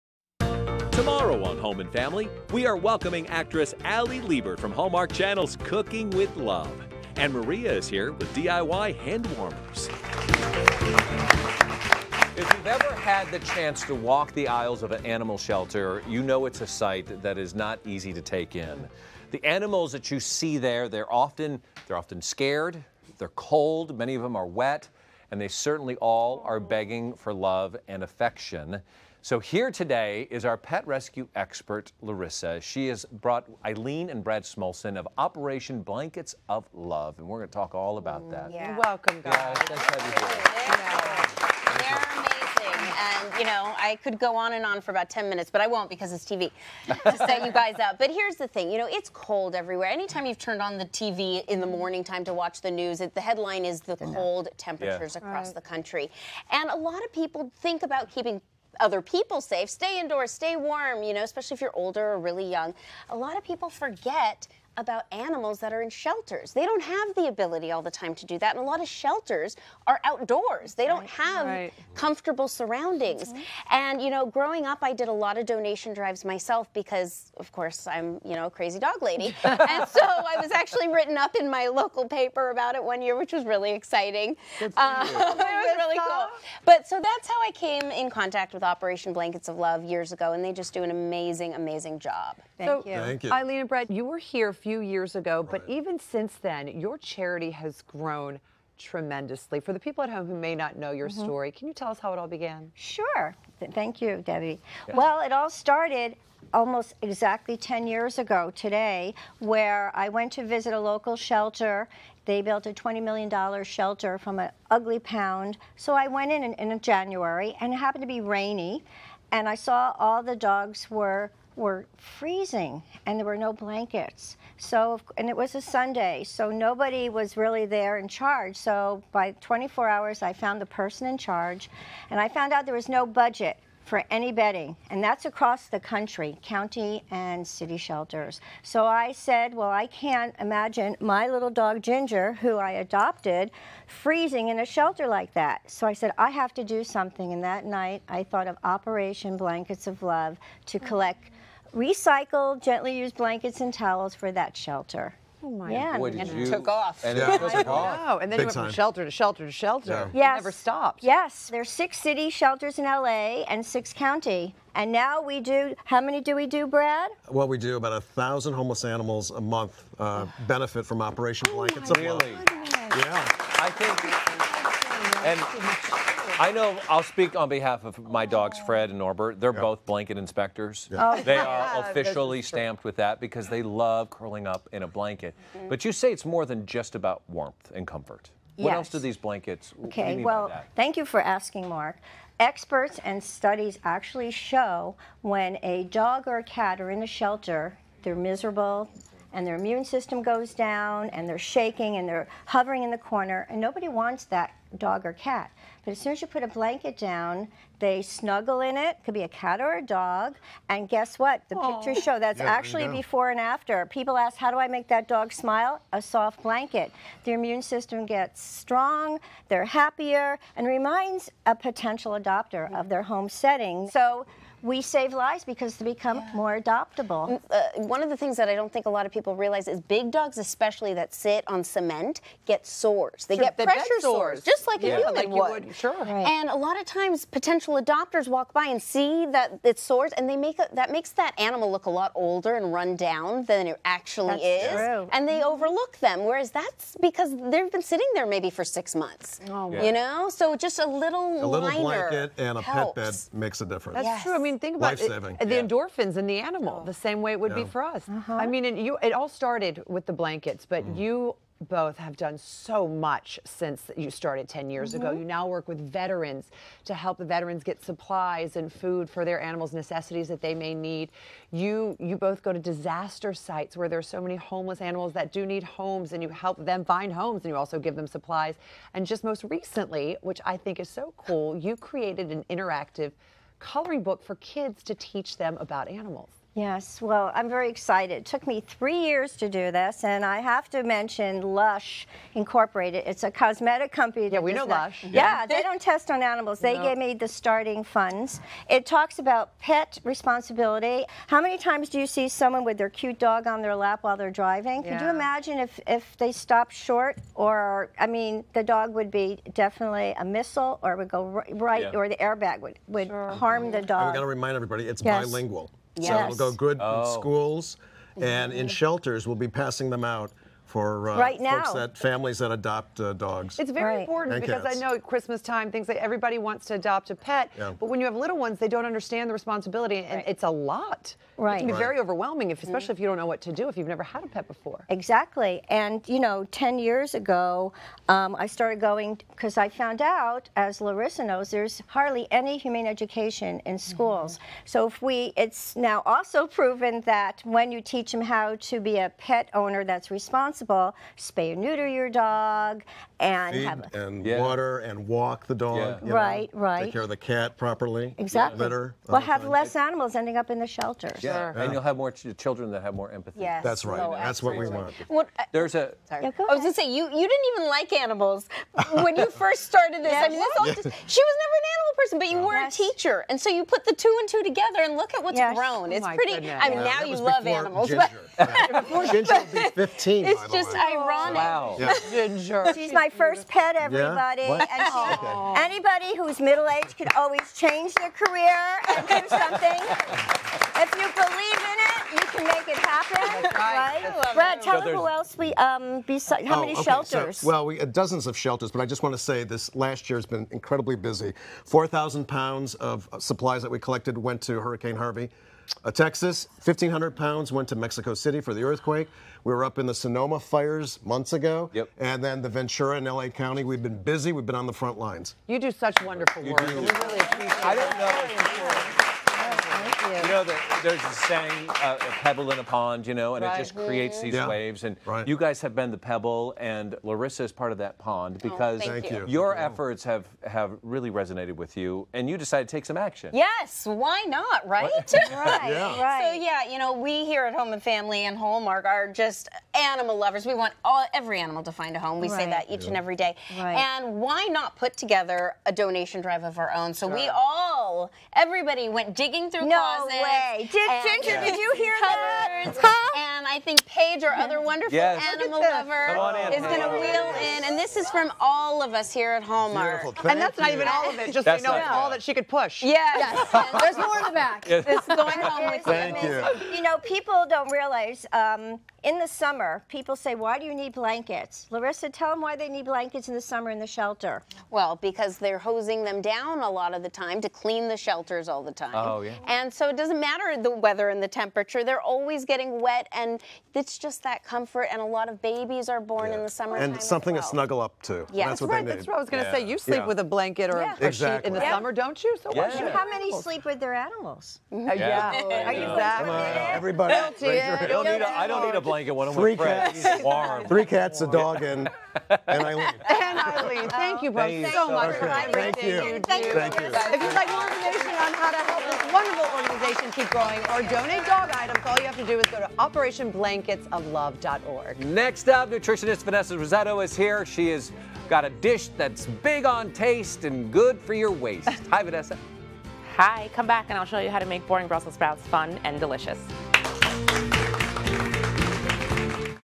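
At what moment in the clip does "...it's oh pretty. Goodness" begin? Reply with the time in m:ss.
6:15.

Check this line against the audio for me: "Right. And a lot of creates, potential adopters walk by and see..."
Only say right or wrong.
wrong.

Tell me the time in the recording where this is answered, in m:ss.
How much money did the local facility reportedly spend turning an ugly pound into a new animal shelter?
1:52.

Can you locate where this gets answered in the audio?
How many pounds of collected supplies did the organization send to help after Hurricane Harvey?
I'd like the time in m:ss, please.
6:41.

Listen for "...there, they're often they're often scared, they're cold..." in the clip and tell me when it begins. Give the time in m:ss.
0:20.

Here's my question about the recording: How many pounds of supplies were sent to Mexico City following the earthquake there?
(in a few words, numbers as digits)
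1,500.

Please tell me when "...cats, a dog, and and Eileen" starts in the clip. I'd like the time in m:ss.
8:20.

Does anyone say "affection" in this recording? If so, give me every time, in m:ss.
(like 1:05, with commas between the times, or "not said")
0:28.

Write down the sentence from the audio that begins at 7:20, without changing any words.
We want all, every animal to find a home.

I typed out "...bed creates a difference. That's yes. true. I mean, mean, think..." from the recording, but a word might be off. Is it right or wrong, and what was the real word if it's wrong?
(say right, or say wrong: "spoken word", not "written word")
wrong: "makes", not "creates".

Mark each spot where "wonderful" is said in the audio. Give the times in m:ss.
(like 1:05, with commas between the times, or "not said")
6:56, 7:34, 8:29.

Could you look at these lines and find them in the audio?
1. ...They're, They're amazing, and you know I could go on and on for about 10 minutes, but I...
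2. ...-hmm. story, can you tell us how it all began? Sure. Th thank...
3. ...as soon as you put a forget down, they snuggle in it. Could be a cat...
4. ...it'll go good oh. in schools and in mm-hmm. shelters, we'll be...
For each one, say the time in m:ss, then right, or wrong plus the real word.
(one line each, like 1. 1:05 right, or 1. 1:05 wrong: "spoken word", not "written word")
1. 0:41 right
2. 1:41 right
3. 3:25 wrong: "blanket", not "forget"
4. 5:16 right.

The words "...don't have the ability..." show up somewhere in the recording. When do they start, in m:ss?
1:06.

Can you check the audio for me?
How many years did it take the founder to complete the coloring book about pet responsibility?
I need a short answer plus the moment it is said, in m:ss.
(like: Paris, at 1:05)
3, at 4:48.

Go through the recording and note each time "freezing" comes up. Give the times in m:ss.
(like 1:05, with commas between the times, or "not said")
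2:01, 2:23.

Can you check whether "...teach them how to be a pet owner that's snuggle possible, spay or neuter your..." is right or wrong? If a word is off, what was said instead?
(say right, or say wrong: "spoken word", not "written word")
wrong: "responsible", not "snuggle".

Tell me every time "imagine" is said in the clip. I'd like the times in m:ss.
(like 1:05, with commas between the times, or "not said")
2:20, 5:05.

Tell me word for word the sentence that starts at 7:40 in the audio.
And that's not even all of it, just so you know, all that she could push.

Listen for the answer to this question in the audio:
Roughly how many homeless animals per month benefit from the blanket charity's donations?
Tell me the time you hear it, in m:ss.
2:47.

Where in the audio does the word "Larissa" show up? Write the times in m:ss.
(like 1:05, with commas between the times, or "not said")
0:32, 5:40, 7:07, 7:51.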